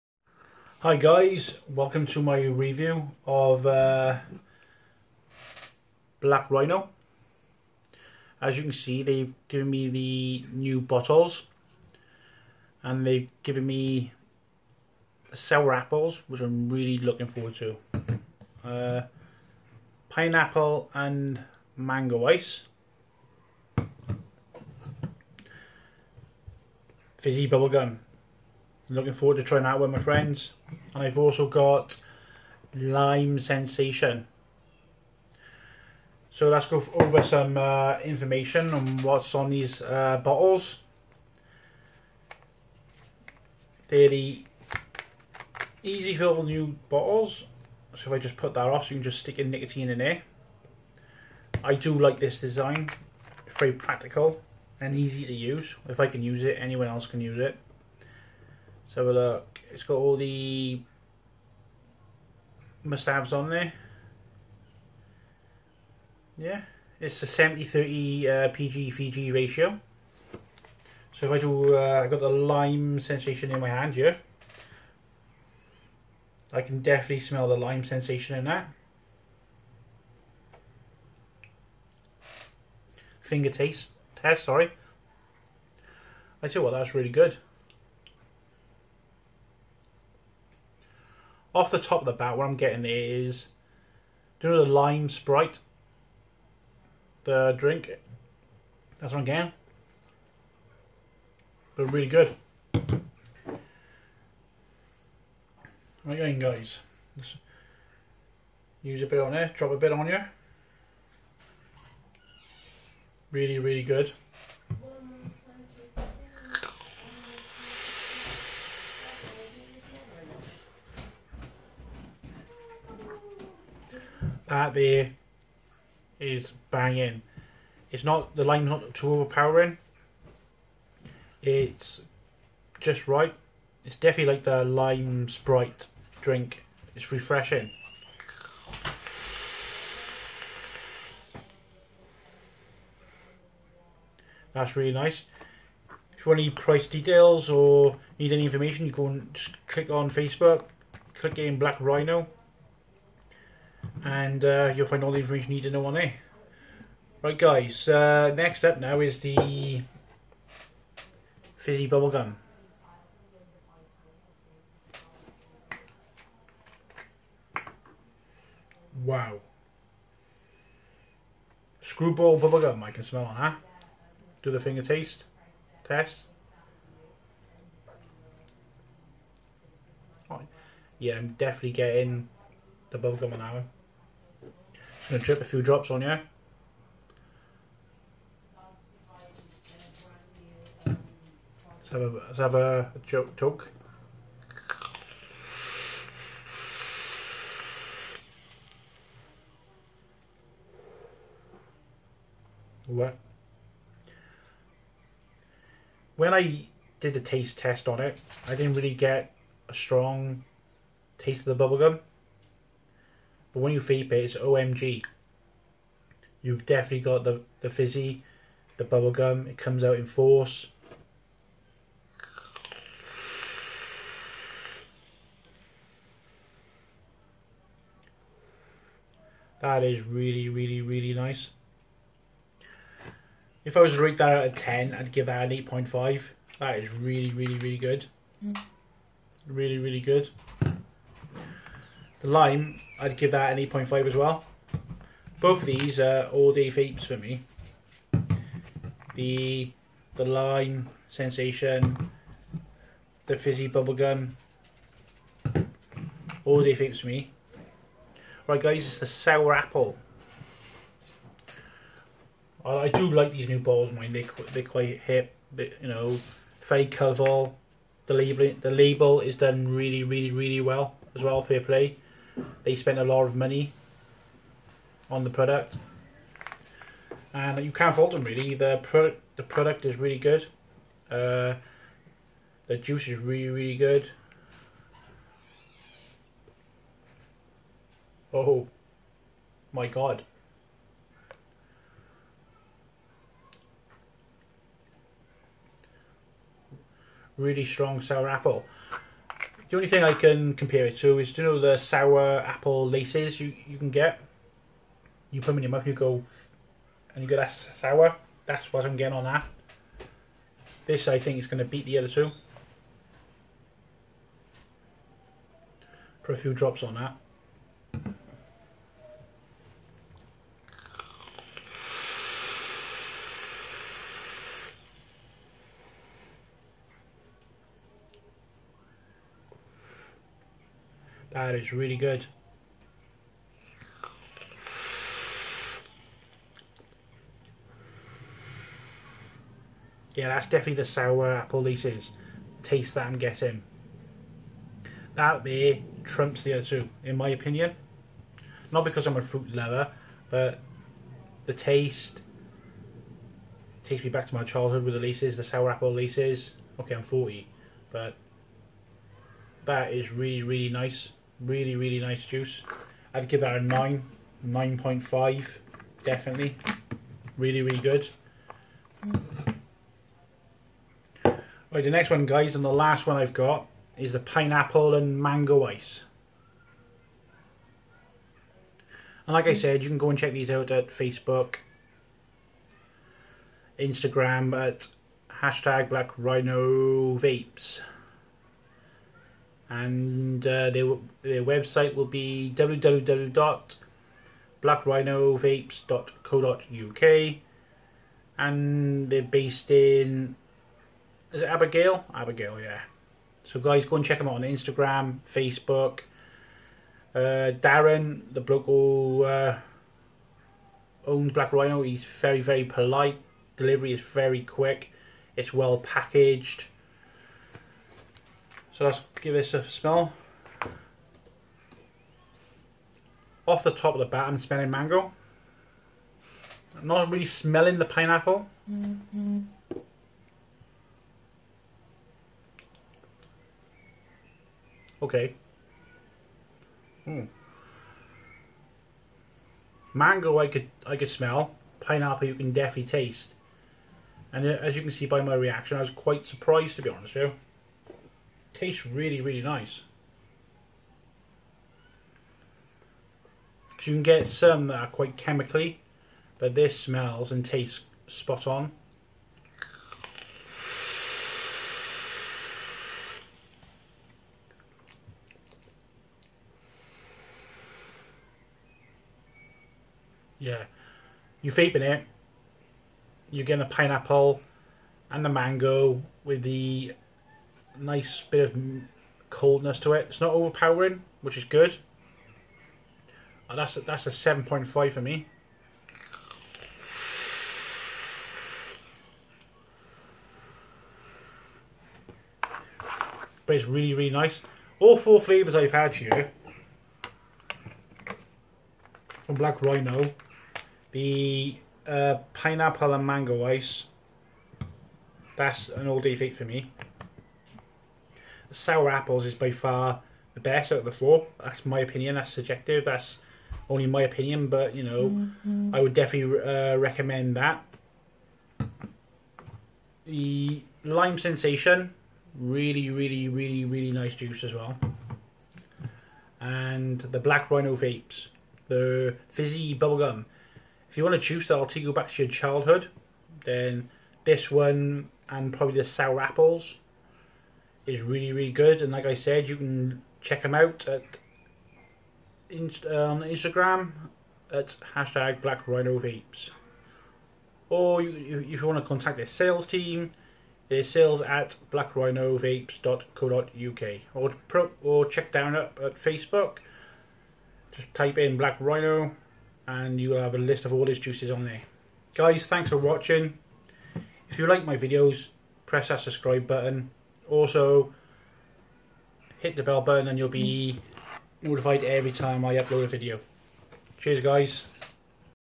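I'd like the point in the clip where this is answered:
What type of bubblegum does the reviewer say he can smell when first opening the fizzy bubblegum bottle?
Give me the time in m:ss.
2:51.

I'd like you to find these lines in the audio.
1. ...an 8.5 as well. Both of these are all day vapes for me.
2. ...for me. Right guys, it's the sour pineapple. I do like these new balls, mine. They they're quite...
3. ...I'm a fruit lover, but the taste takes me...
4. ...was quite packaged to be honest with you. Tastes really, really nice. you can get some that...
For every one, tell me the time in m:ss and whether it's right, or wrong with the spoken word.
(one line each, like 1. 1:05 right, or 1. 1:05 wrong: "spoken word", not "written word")
1. 4:03 right
2. 4:17 wrong: "apple", not "pineapple"
3. 5:49 right
4. 7:25 wrong: "surprised", not "packaged".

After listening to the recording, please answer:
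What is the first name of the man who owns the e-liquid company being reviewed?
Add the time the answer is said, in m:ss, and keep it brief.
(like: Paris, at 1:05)
Darren, at 6:47.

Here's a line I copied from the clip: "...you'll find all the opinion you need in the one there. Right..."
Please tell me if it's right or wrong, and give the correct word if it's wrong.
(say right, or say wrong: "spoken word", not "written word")
wrong: "information", not "opinion".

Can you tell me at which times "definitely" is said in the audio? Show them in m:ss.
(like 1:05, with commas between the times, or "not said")
1:16, 2:13, 3:01, 3:36, 5:40, 6:06, 7:22, 8:35.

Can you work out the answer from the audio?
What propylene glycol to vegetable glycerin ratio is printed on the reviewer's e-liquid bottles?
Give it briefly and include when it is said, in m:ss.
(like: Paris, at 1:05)
70-30, at 1:07.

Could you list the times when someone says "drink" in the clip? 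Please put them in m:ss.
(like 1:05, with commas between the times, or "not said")
1:37, 2:16.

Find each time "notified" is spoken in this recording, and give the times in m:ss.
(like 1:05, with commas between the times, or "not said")
9:31.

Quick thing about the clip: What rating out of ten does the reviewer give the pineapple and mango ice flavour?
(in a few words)
7.5.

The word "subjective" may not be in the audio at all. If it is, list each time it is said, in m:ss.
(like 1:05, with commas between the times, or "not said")
8:32.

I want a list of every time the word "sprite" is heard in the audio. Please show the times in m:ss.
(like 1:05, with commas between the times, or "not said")
1:35, 2:15.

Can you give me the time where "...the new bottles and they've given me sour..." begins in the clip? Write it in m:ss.
0:09.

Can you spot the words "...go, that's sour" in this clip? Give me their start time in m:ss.
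5:07.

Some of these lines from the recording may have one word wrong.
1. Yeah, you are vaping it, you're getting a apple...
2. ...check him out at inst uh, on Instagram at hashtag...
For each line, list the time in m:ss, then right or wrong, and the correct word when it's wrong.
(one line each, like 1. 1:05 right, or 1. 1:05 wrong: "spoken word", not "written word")
1. 7:50 wrong: "pineapple", not "apple"
2. 9:00 right.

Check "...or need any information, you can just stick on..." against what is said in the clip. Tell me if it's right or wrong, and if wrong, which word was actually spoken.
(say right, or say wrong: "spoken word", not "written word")
wrong: "click", not "stick".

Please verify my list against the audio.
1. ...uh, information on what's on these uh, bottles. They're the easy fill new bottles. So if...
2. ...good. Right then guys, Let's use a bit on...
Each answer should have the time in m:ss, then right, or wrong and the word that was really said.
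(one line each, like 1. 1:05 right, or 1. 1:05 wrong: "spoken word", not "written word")
1. 0:37 right
2. 1:42 right.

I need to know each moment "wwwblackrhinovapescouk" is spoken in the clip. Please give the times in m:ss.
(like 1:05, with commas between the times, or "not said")
6:32.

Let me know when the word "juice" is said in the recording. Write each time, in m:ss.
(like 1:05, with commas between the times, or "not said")
4:42, 6:02, 8:44, 8:51, 9:20.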